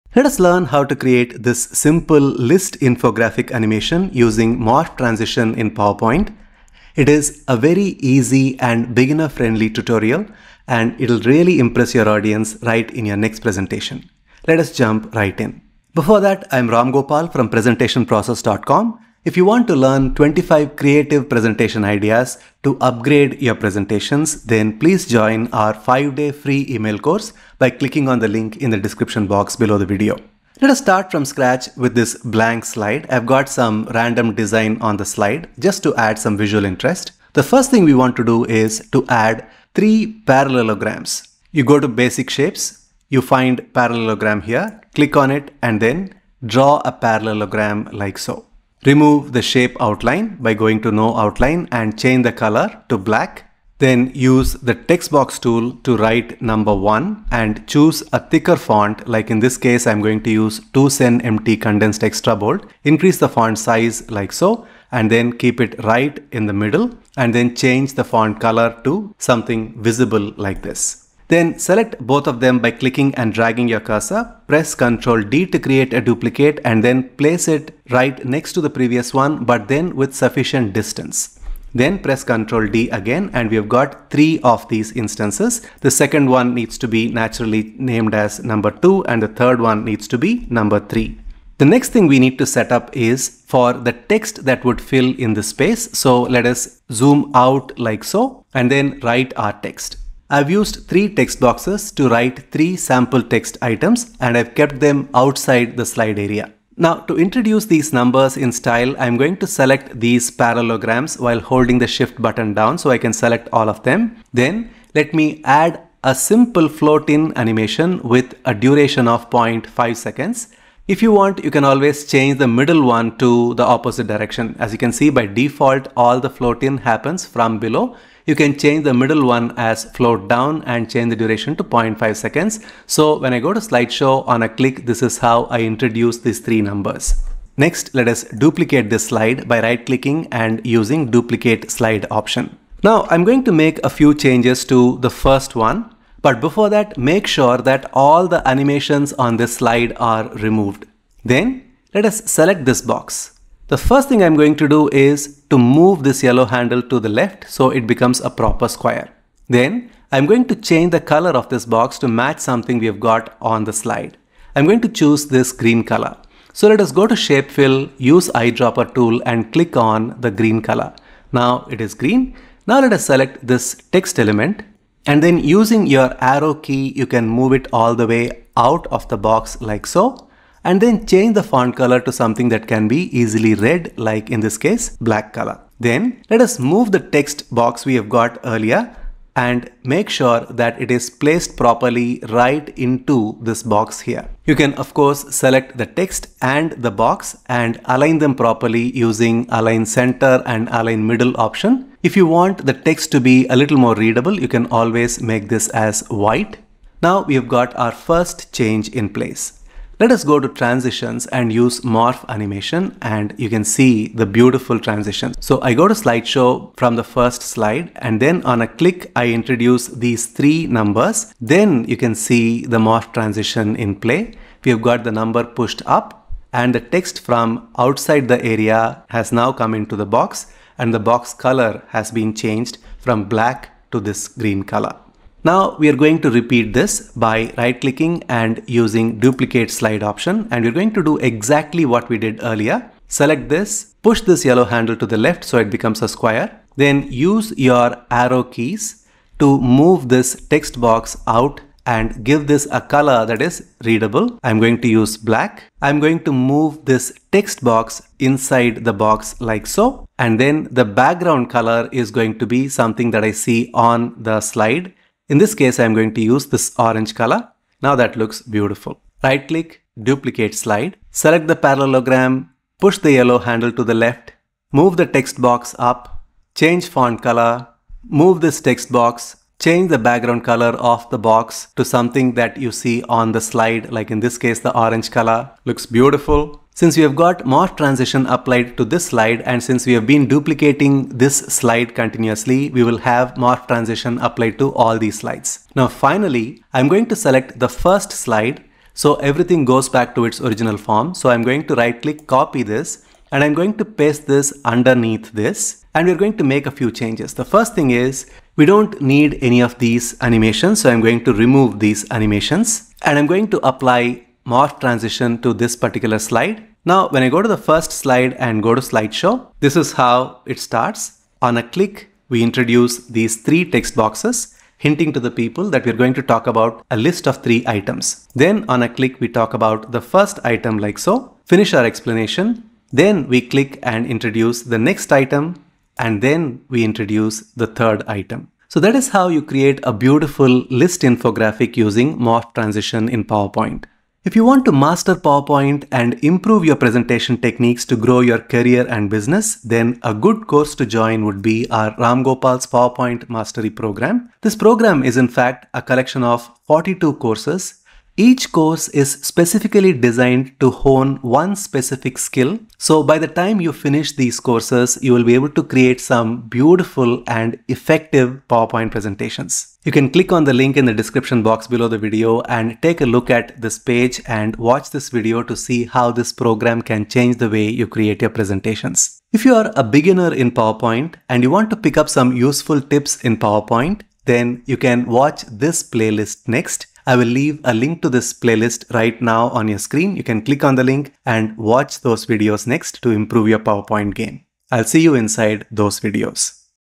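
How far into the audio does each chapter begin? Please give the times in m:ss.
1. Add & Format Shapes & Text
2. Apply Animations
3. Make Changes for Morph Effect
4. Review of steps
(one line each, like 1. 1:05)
1. 0:40
2. 1:55
3. 2:26
4. 5:20.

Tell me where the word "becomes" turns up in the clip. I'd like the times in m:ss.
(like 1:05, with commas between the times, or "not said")
2:37, 4:05.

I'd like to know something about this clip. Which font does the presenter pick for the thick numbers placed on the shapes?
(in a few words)
Tw Cen MT condensed extra bold.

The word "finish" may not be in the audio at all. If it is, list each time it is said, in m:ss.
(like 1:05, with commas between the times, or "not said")
5:31, 6:03.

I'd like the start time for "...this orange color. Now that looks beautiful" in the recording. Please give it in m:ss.
4:26.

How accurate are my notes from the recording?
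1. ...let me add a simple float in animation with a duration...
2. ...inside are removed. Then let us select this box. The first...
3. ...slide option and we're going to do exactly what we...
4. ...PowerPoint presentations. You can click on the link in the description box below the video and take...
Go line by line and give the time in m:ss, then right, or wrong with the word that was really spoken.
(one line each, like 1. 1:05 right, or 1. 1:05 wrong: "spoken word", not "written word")
1. 1:54 right
2. 2:29 wrong: "slide", not "inside"
3. 3:59 right
4. 6:08 right.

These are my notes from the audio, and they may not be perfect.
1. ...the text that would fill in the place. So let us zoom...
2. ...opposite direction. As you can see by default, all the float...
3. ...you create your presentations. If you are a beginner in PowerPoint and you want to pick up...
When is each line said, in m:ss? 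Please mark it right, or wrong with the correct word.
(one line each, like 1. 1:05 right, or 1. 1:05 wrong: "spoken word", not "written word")
1. 1:33 wrong: "space", not "place"
2. 2:03 right
3. 6:17 right.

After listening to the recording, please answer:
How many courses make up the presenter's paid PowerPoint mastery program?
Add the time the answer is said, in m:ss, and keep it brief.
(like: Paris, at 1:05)
42, at 5:56.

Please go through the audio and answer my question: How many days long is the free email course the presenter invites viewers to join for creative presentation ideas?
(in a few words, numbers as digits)
5-day.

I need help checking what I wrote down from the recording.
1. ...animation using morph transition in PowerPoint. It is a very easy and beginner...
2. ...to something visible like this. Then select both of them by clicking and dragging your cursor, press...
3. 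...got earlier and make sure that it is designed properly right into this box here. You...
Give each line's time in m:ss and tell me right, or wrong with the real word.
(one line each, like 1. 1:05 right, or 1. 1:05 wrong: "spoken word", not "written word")
1. 0:03 right
2. 1:08 right
3. 3:08 wrong: "placed", not "designed".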